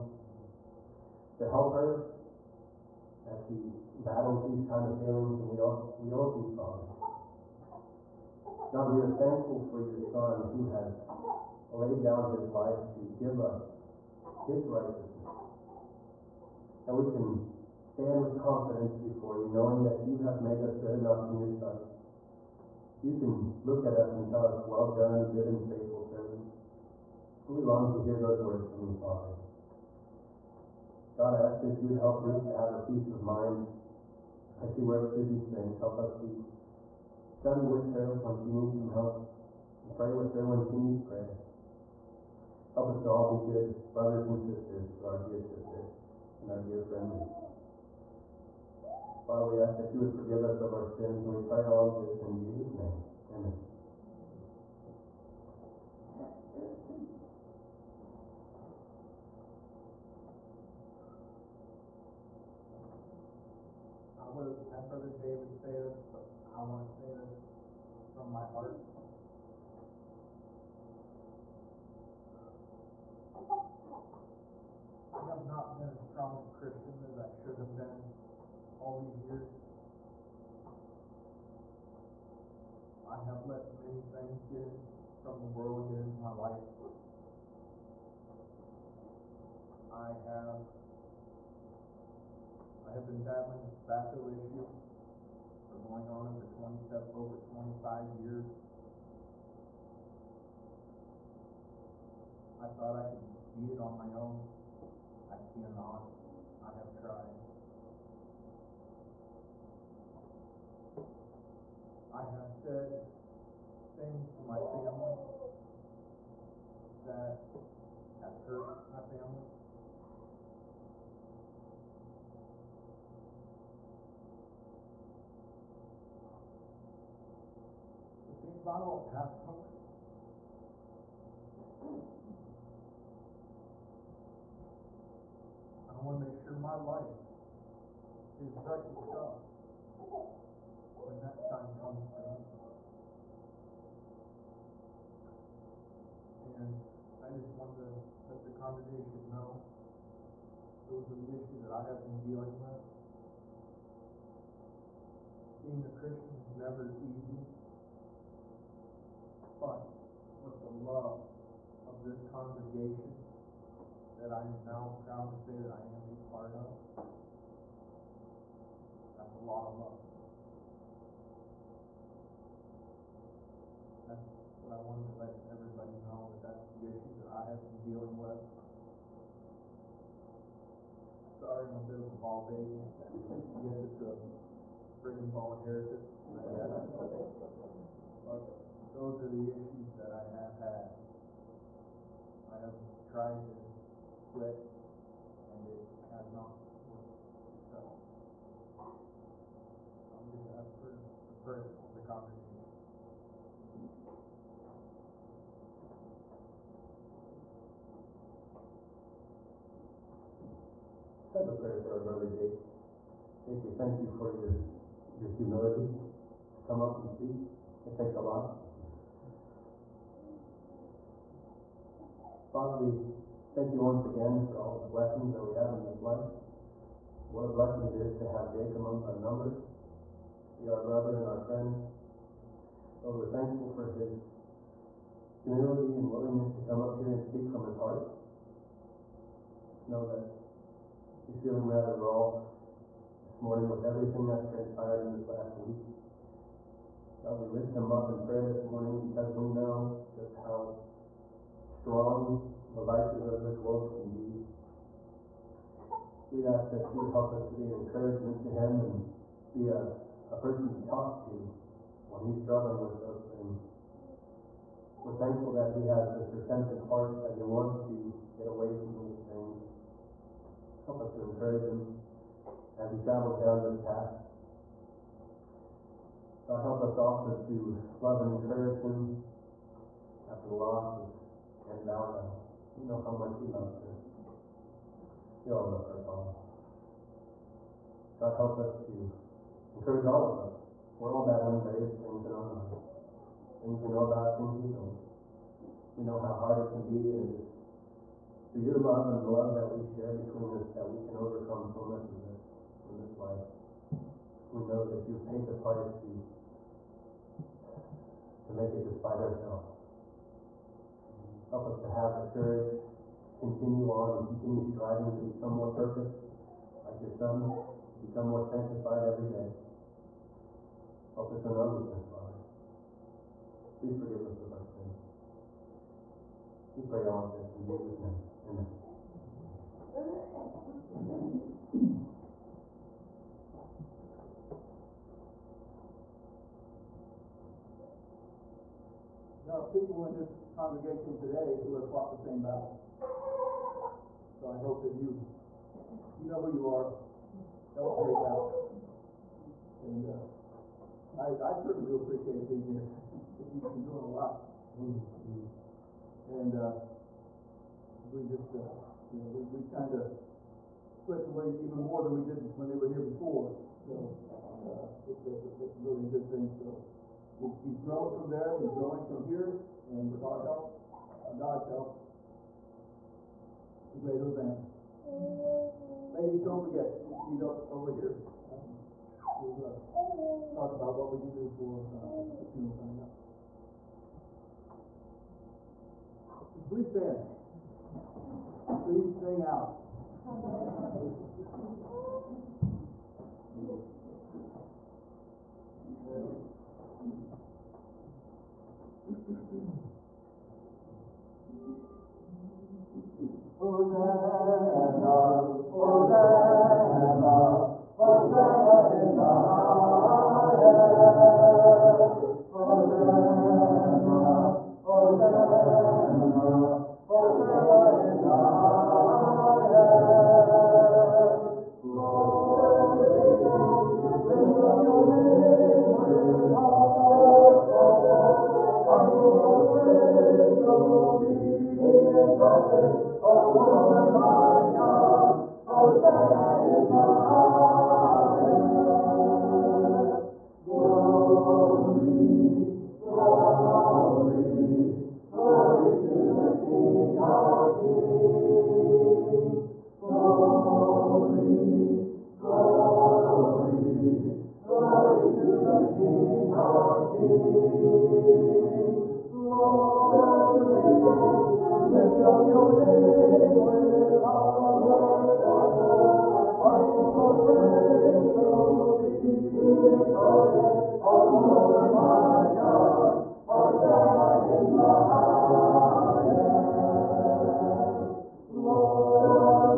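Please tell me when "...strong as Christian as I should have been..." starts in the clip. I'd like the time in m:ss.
1:16.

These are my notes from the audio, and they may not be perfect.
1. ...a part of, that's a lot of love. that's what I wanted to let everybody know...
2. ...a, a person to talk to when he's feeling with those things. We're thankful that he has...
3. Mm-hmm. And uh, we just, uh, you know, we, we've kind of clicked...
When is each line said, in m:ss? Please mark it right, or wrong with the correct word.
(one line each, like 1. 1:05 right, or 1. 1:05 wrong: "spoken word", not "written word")
1. 2:46 right
2. 4:19 wrong: "struggling", not "feeling"
3. 5:54 right.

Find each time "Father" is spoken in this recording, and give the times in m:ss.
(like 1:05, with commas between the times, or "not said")
0:06, 0:28, 0:49, 3:42, 4:46, 5:22.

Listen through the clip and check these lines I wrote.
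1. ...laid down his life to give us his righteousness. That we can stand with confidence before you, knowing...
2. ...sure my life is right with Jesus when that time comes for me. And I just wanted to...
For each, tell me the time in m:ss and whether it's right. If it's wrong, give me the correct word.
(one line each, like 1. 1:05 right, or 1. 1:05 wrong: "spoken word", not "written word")
1. 0:11 right
2. 2:16 wrong: "God", not "Jesus".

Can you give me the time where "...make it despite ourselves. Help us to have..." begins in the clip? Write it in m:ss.
5:08.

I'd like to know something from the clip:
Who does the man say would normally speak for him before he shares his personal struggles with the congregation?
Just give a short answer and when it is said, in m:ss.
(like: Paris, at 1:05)
Brother David, at 1:04.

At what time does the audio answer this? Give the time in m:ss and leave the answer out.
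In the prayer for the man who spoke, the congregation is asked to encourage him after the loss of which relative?
4:41.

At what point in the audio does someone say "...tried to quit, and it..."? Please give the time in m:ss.
3:13.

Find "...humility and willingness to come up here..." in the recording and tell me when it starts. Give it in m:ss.
3:55.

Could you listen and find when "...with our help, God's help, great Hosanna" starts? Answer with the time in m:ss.
6:10.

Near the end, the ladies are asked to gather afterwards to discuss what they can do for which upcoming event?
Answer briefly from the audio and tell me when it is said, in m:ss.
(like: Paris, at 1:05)
the funeral, at 6:22.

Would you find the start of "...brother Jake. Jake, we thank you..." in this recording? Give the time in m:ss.
3:32.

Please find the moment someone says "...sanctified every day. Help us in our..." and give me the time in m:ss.
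5:18.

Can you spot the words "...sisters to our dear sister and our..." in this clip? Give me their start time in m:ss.
0:44.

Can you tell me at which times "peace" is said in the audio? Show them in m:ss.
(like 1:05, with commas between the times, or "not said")
0:32.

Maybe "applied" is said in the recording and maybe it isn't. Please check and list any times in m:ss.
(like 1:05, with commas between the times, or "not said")
not said.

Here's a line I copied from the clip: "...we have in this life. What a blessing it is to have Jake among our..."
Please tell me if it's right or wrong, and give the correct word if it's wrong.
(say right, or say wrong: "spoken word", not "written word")
right.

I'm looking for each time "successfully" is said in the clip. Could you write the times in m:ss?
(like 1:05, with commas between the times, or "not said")
3:17.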